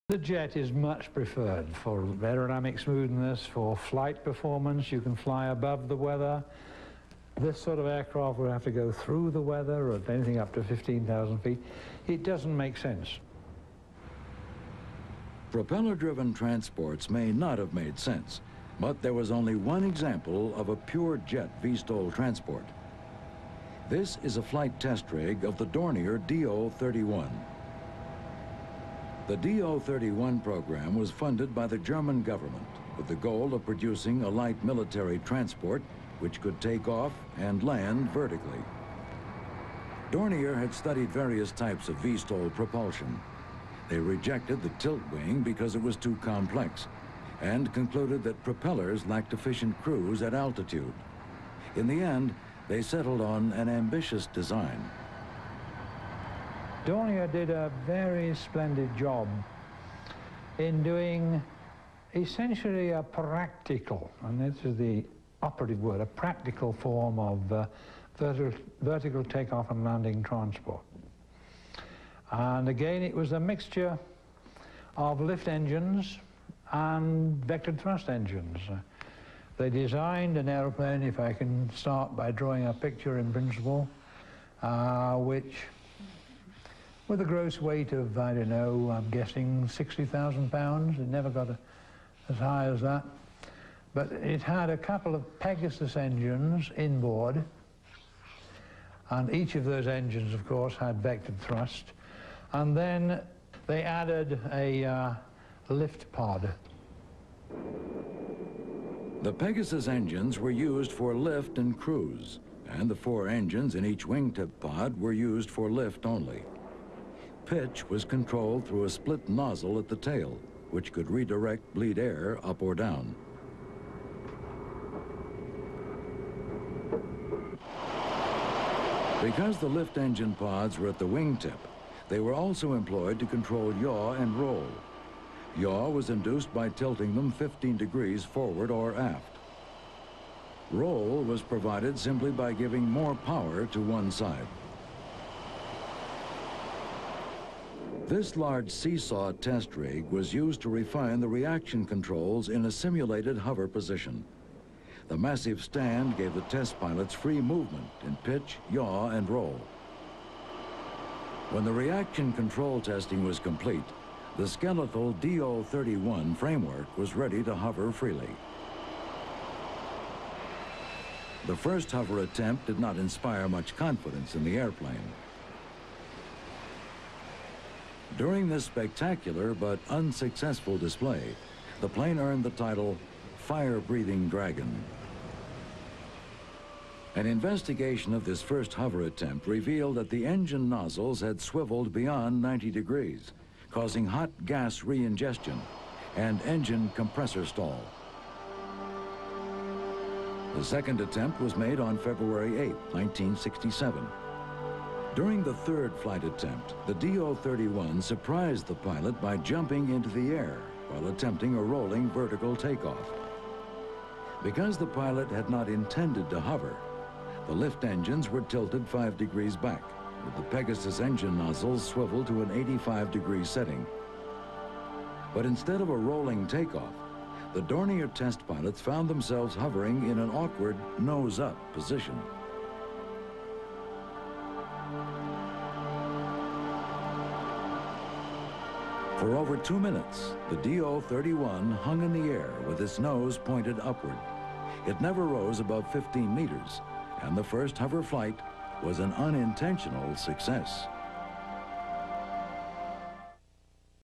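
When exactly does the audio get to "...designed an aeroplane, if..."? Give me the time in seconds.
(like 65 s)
79 s.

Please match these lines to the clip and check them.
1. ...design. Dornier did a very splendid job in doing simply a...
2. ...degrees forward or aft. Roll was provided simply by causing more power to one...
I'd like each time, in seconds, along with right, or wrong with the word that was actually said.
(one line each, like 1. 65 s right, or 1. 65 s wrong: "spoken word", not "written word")
1. 54 s wrong: "essentially", not "simply"
2. 137 s wrong: "giving", not "causing".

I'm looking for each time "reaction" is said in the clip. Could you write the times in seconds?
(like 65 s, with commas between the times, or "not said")
151 s, 161 s.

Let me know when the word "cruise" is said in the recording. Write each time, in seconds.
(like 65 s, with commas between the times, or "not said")
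49 s, 111 s.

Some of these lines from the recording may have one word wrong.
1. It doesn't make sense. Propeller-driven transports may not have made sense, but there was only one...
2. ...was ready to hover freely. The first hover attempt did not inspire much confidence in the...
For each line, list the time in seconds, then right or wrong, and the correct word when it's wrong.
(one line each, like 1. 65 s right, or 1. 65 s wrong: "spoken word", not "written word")
1. 12 s right
2. 166 s right.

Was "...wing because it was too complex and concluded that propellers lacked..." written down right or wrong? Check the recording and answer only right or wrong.
right.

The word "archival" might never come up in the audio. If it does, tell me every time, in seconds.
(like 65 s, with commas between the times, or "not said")
not said.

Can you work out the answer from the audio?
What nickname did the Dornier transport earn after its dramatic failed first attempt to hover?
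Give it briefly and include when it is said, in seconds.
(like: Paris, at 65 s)
Fire-Breathing Dragon, at 183 s.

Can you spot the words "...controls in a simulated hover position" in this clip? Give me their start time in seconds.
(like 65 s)
151 s.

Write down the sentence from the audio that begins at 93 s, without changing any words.
But it had a couple of Pegasus engines inboard, and each of those engines, of course, had vectored thrust.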